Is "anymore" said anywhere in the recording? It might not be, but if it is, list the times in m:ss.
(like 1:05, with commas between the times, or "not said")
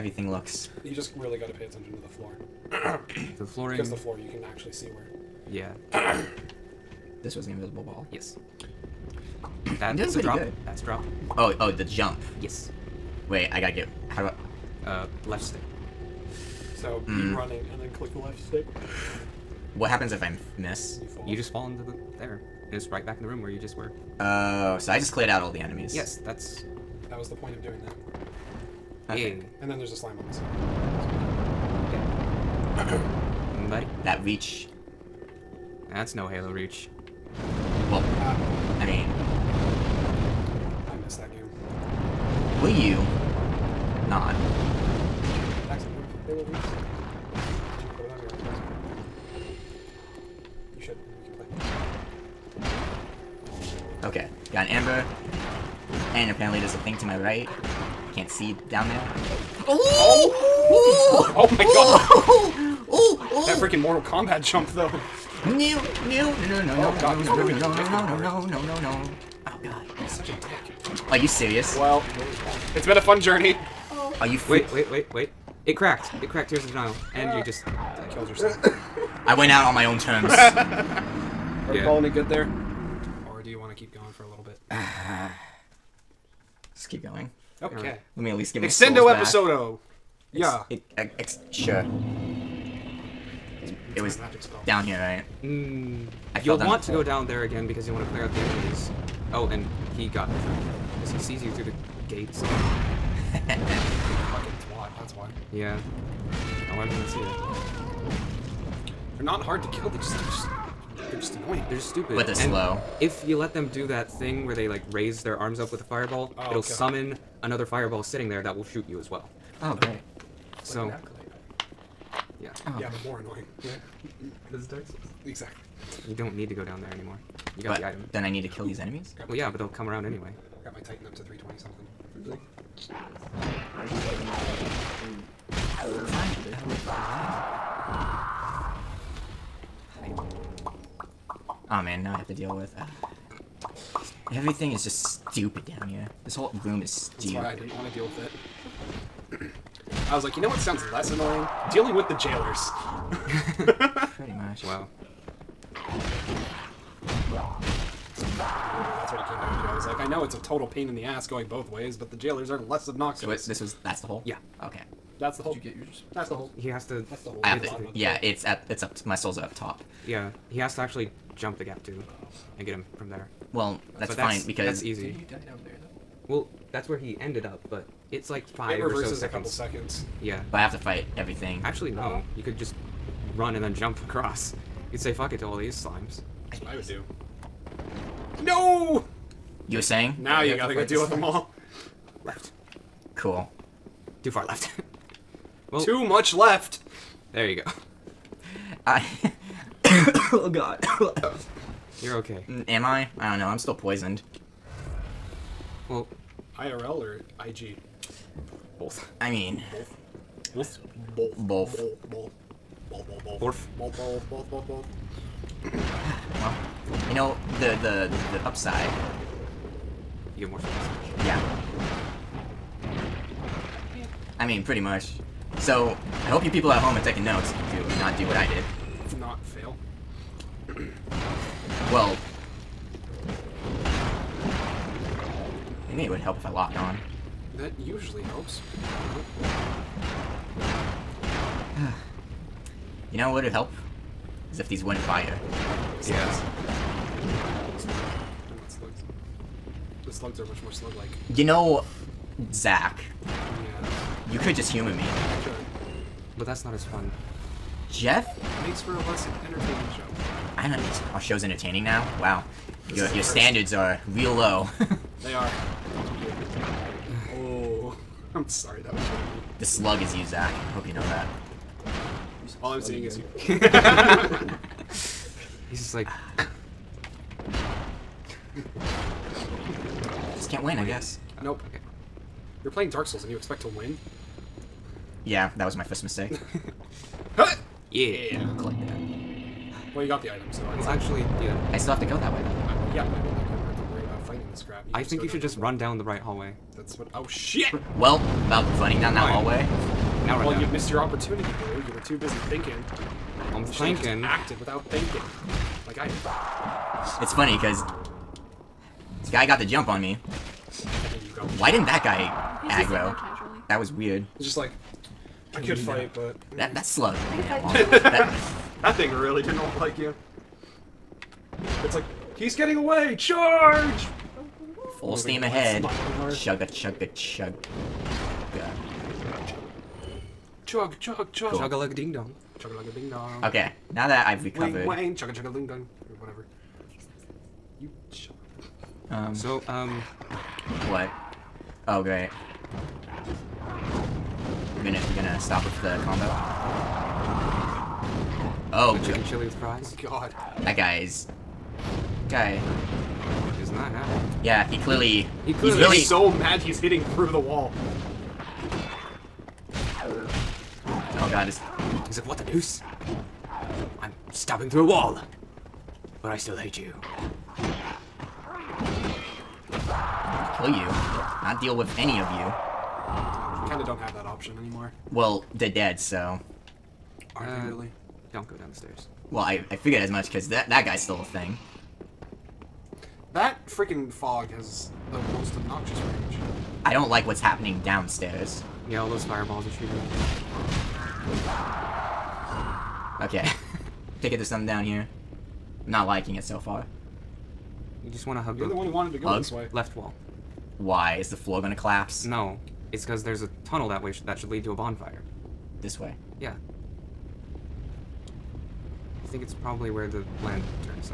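2:06, 6:14.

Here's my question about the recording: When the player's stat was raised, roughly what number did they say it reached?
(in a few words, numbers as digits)
320 something.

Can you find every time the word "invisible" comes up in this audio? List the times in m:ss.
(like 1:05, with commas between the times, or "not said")
0:07.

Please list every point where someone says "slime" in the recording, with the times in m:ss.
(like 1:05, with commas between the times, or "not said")
0:29, 3:05.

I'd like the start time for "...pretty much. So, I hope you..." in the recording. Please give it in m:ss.
3:44.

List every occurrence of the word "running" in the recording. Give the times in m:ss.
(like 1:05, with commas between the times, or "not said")
0:17, 4:58.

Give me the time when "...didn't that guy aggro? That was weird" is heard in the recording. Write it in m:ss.
5:11.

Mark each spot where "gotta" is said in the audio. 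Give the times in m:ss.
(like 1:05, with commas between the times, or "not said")
0:13, 3:10.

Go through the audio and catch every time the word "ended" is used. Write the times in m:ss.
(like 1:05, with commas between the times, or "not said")
2:57.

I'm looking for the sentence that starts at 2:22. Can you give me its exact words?
Uh, everything is just stupid down here.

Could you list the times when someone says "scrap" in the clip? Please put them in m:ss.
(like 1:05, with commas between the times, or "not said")
4:54.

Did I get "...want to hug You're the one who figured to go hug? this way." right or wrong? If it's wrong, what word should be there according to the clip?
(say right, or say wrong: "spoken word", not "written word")
wrong: "wanted", not "figured".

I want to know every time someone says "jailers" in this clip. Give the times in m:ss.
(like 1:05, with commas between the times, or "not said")
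2:32, 2:42.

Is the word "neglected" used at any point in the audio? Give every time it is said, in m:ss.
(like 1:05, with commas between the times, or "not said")
not said.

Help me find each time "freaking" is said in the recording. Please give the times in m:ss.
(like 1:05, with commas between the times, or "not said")
1:03, 6:23.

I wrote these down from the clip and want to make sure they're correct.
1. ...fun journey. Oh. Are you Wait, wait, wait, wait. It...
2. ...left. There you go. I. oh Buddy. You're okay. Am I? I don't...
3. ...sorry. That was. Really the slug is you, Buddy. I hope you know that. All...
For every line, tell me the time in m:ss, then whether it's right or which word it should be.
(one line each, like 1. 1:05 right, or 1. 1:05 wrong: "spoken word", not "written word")
1. 1:12 right
2. 3:16 wrong: "God", not "Buddy"
3. 4:28 wrong: "Zach", not "Buddy".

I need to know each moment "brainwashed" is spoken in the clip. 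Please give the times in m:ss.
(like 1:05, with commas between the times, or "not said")
not said.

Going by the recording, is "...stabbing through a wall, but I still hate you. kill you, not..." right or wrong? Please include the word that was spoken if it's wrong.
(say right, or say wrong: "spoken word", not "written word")
right.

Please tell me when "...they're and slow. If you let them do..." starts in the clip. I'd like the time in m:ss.
1:52.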